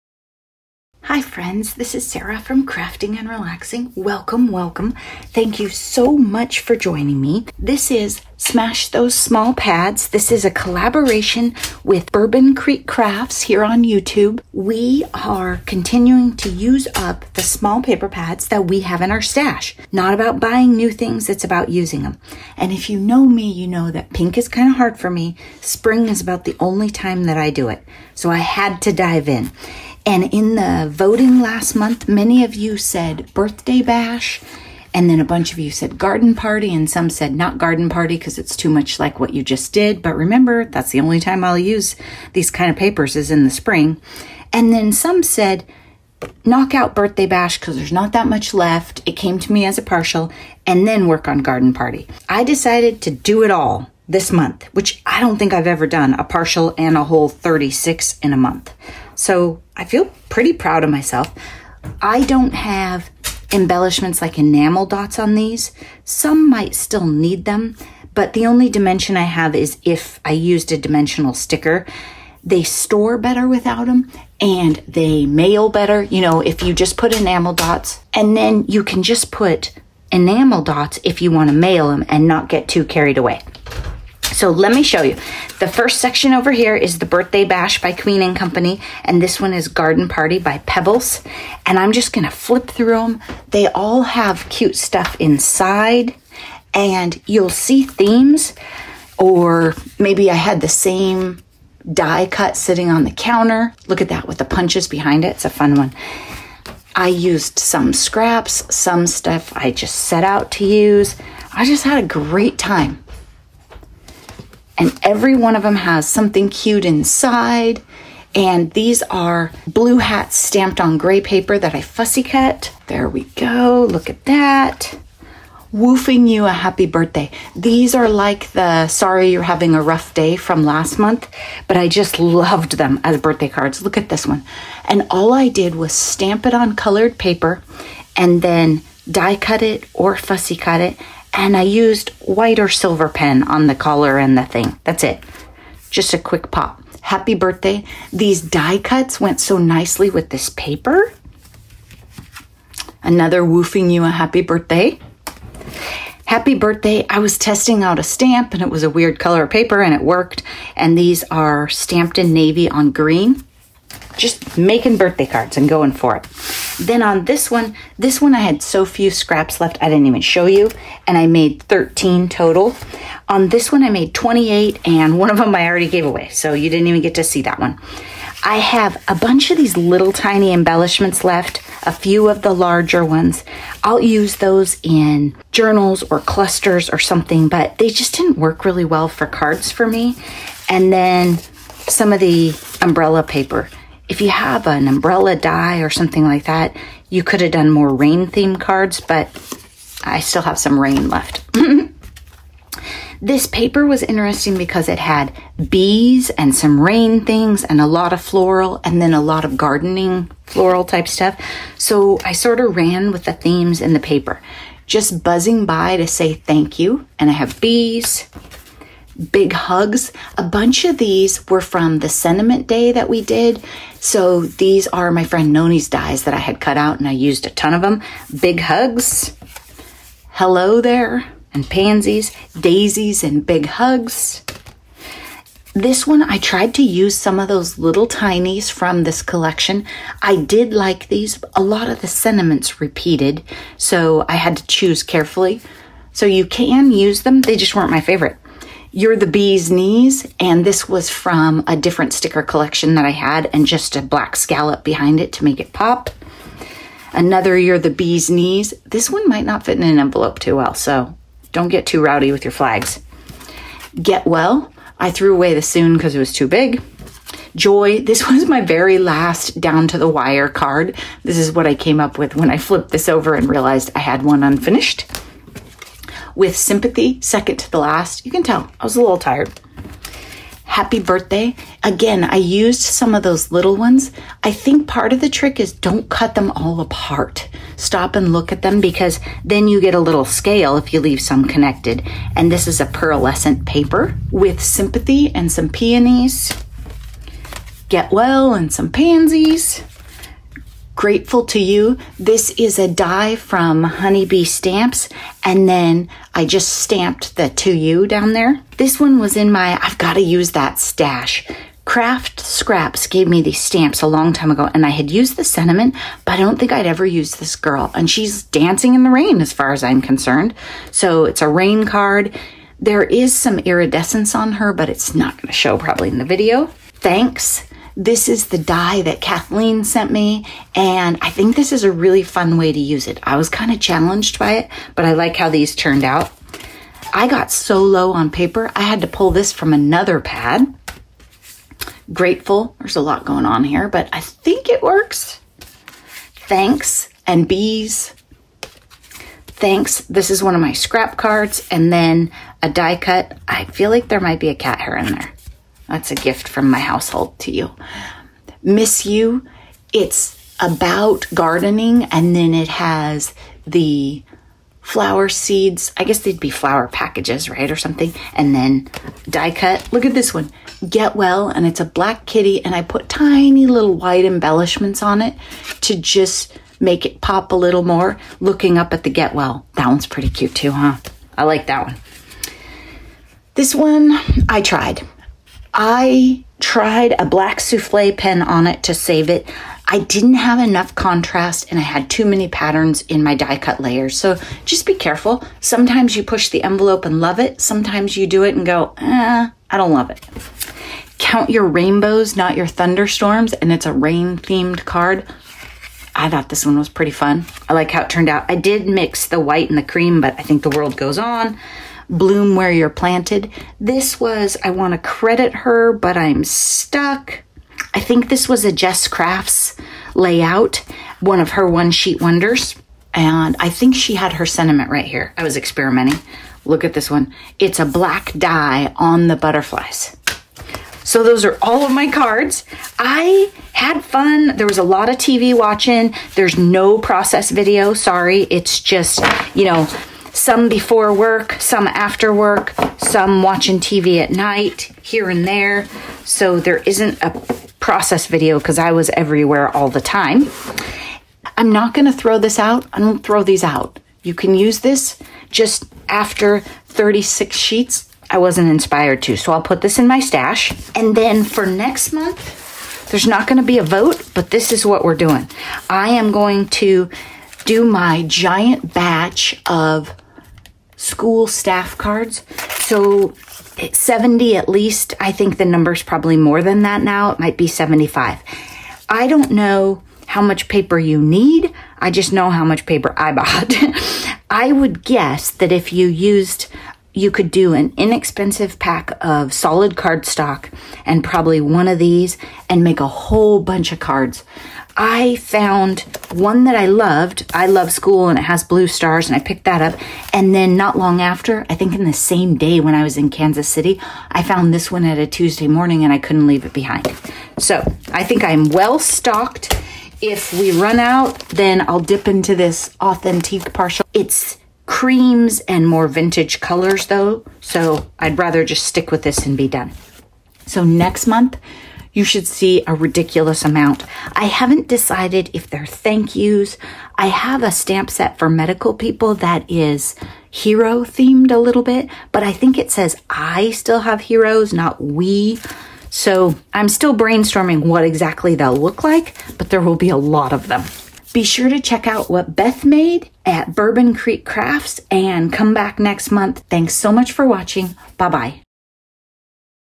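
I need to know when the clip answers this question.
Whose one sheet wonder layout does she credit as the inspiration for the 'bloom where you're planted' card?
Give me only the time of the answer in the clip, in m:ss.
6:58.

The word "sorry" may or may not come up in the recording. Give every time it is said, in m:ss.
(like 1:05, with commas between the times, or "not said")
2:08, 7:17.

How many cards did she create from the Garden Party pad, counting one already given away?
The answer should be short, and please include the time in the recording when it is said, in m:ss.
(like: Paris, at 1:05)
28, at 2:54.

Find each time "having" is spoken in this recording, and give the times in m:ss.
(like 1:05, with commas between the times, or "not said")
2:09.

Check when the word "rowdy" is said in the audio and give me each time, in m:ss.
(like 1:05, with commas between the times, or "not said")
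4:22.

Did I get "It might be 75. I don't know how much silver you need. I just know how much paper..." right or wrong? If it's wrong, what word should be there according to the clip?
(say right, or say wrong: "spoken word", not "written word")
wrong: "paper", not "silver".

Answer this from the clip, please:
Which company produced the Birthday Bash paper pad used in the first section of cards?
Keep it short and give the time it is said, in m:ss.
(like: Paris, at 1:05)
Queen and Company, at 1:27.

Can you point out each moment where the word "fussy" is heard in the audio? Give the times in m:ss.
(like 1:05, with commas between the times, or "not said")
2:01, 2:20.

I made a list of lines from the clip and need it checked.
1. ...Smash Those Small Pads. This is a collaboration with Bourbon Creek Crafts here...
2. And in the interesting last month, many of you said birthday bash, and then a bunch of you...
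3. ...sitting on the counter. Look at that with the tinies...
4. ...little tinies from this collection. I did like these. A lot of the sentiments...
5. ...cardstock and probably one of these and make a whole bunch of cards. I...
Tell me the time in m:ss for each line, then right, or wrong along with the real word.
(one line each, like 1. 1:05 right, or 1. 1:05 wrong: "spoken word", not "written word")
1. 0:08 right
2. 0:30 wrong: "voting", not "interesting"
3. 1:42 wrong: "punches", not "tinies"
4. 3:57 right
5. 8:09 right.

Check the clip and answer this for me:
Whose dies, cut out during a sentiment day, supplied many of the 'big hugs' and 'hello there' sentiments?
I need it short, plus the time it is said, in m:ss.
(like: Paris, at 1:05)
Noni, at 3:45.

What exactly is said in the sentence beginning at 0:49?
It came to me as a partial, and then work on garden party.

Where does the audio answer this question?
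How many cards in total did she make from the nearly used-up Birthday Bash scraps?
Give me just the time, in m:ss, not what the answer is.
2:51.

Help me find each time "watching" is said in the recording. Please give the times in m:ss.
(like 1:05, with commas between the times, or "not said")
7:15, 7:23, 9:07.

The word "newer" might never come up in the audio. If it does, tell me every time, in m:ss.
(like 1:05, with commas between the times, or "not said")
not said.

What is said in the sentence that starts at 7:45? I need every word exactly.
I am going to do my giant batch of school staff cards.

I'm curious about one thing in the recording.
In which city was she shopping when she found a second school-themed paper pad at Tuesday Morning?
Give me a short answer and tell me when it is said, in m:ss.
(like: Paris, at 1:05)
Kansas City, at 8:23.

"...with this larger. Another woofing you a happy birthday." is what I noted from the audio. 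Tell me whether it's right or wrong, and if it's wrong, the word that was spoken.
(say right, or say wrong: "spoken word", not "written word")
wrong: "paper", not "larger".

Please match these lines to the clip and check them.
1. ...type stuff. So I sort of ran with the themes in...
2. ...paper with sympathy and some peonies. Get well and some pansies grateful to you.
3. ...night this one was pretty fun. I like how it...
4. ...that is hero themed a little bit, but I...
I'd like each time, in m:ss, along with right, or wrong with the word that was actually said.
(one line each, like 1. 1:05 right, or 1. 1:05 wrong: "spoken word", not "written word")
1. 3:30 right
2. 4:53 right
3. 6:46 wrong: "thought", not "night"
4. 8:49 right.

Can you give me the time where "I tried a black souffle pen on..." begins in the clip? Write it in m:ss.
6:25.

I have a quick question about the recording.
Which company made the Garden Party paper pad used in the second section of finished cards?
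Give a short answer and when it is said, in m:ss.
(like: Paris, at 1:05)
Pebbles, at 1:30.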